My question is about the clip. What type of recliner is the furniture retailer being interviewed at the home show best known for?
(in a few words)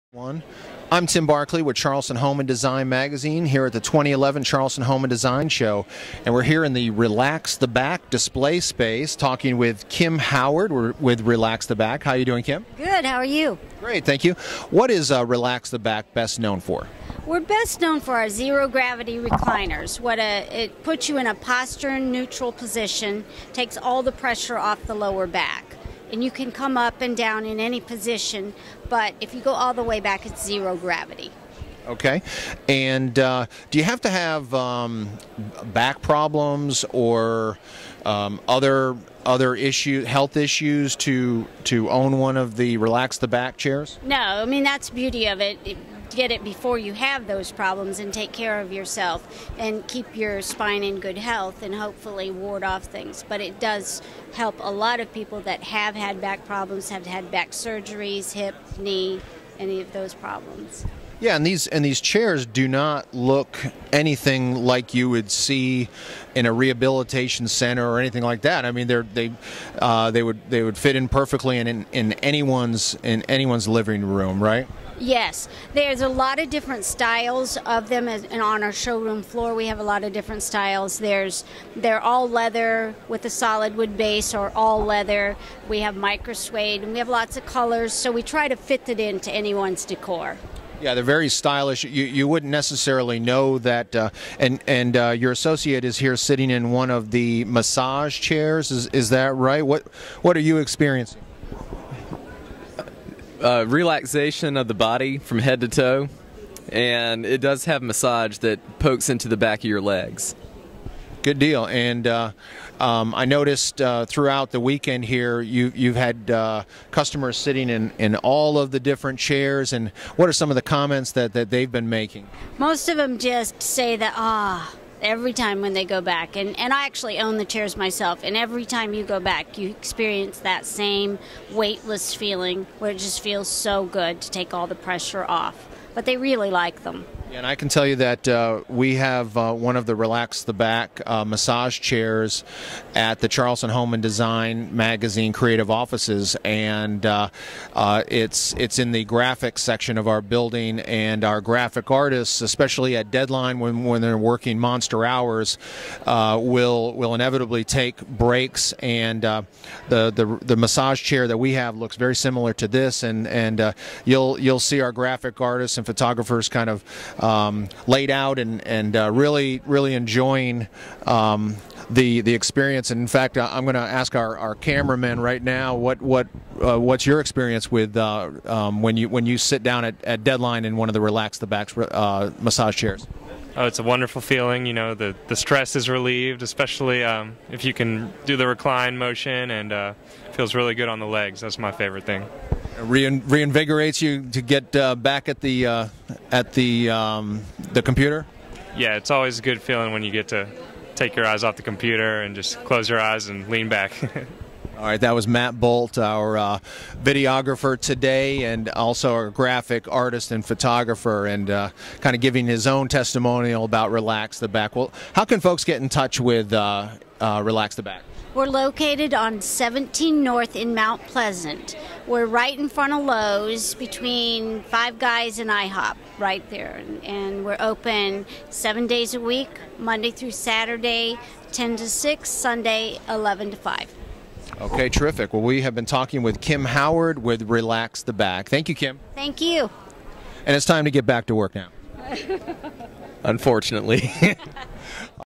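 zero gravity recliners.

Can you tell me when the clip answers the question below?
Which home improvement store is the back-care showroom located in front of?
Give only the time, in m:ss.
3:43.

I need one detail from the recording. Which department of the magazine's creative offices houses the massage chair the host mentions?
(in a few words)
graphics section.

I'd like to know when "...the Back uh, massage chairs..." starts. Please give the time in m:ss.
2:20.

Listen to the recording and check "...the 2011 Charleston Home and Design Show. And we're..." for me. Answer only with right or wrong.
right.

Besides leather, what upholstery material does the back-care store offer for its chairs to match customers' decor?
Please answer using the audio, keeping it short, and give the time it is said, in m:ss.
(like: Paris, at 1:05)
micro suede, at 1:25.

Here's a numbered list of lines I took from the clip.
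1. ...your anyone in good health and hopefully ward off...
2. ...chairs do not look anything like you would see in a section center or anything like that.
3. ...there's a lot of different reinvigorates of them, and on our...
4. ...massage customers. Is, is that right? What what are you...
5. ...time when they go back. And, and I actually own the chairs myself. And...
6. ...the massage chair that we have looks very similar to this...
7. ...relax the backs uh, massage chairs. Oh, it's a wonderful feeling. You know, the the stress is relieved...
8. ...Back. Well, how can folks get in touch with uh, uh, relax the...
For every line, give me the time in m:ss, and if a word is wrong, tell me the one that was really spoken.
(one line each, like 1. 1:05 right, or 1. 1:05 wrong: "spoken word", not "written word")
1. 0:50 wrong: "spine", not "anyone"
2. 1:02 wrong: "rehabilitation", not "section"
3. 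1:15 wrong: "styles", not "reinvigorates"
4. 1:37 wrong: "chairs", not "customers"
5. 2:05 right
6. 2:40 right
7. 3:01 right
8. 3:34 right.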